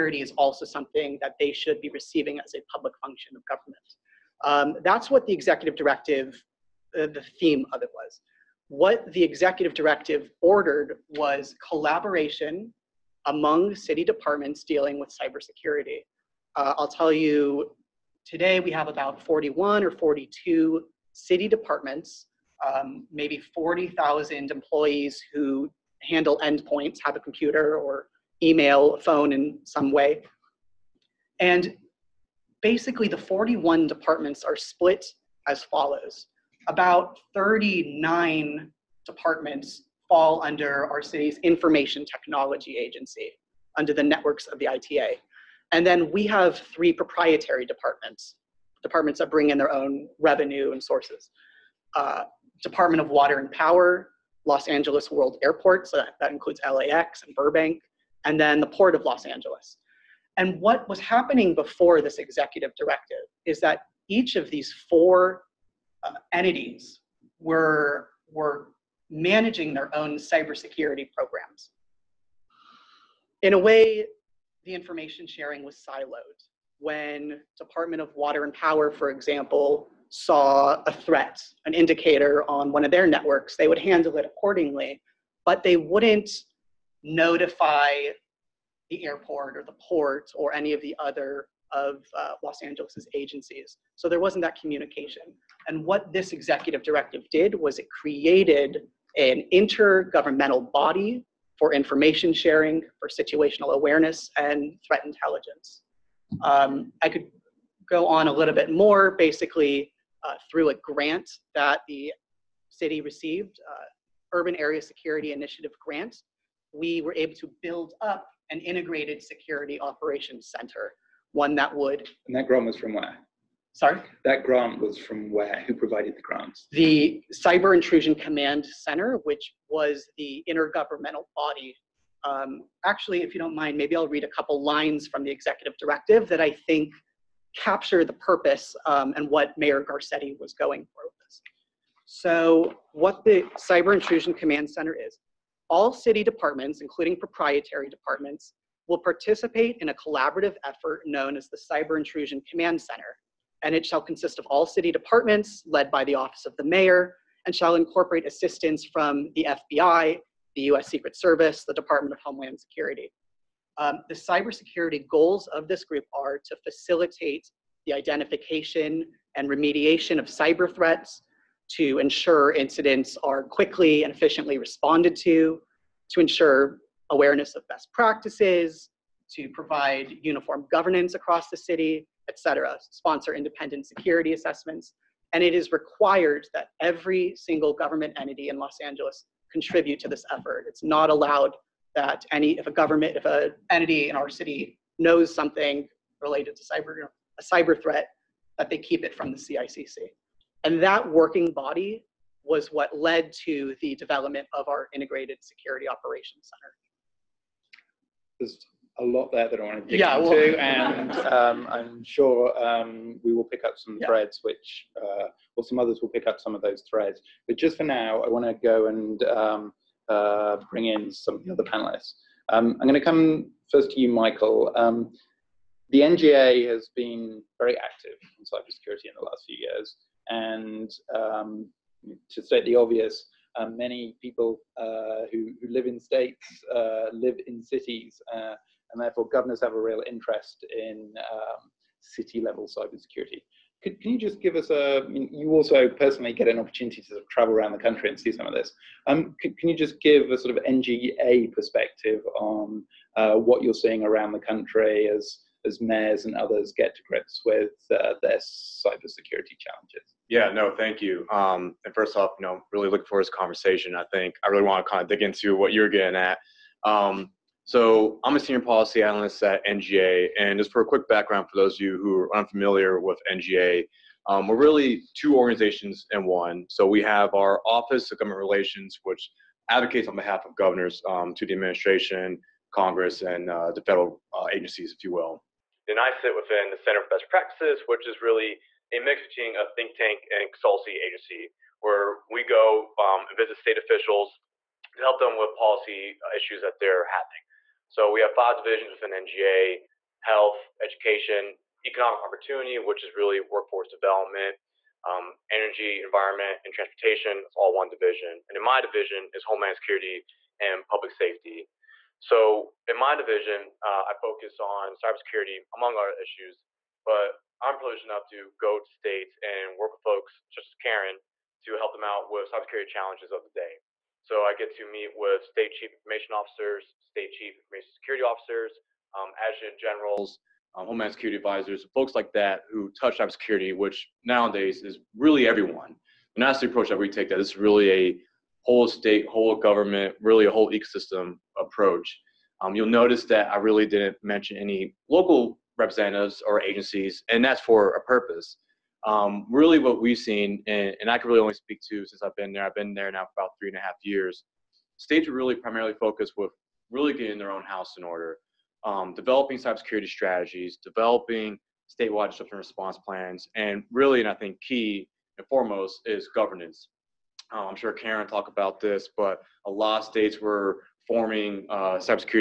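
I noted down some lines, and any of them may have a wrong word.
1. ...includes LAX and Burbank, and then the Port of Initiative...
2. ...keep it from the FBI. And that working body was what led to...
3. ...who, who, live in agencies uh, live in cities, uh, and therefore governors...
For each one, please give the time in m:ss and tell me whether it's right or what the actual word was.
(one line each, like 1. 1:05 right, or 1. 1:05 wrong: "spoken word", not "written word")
1. 0:56 wrong: "Los", not "Initiative"
2. 3:18 wrong: "CICC", not "FBI"
3. 3:55 wrong: "states", not "agencies".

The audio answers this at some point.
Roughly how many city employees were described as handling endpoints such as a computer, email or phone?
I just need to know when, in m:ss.
0:23.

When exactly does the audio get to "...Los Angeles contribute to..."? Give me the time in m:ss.
3:08.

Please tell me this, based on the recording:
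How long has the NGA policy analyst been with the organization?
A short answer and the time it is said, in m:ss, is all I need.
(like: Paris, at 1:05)
About three and a half years, at 5:53.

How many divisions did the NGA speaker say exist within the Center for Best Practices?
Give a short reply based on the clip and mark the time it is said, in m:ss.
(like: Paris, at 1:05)
5, at 4:58.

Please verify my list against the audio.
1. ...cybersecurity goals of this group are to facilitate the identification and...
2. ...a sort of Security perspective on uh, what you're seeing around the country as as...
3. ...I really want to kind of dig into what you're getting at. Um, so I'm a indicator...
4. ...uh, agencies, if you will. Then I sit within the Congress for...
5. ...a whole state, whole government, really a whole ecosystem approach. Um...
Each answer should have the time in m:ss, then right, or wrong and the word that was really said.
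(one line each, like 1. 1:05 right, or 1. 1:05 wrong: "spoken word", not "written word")
1. 2:44 right
2. 4:10 wrong: "NGA", not "Security"
3. 4:24 wrong: "senior", not "indicator"
4. 4:44 wrong: "Center", not "Congress"
5. 5:37 right.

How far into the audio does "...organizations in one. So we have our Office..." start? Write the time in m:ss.
4:35.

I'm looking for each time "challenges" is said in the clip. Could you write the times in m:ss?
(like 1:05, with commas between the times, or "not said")
4:19, 5:22.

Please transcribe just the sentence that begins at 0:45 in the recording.
And then we have three proprietary departments, departments that bring in their own revenue and sources.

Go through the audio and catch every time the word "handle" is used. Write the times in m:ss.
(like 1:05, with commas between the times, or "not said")
0:26, 1:23.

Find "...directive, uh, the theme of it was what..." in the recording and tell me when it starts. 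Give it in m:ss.
0:05.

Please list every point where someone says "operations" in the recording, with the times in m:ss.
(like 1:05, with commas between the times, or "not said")
1:59, 3:25.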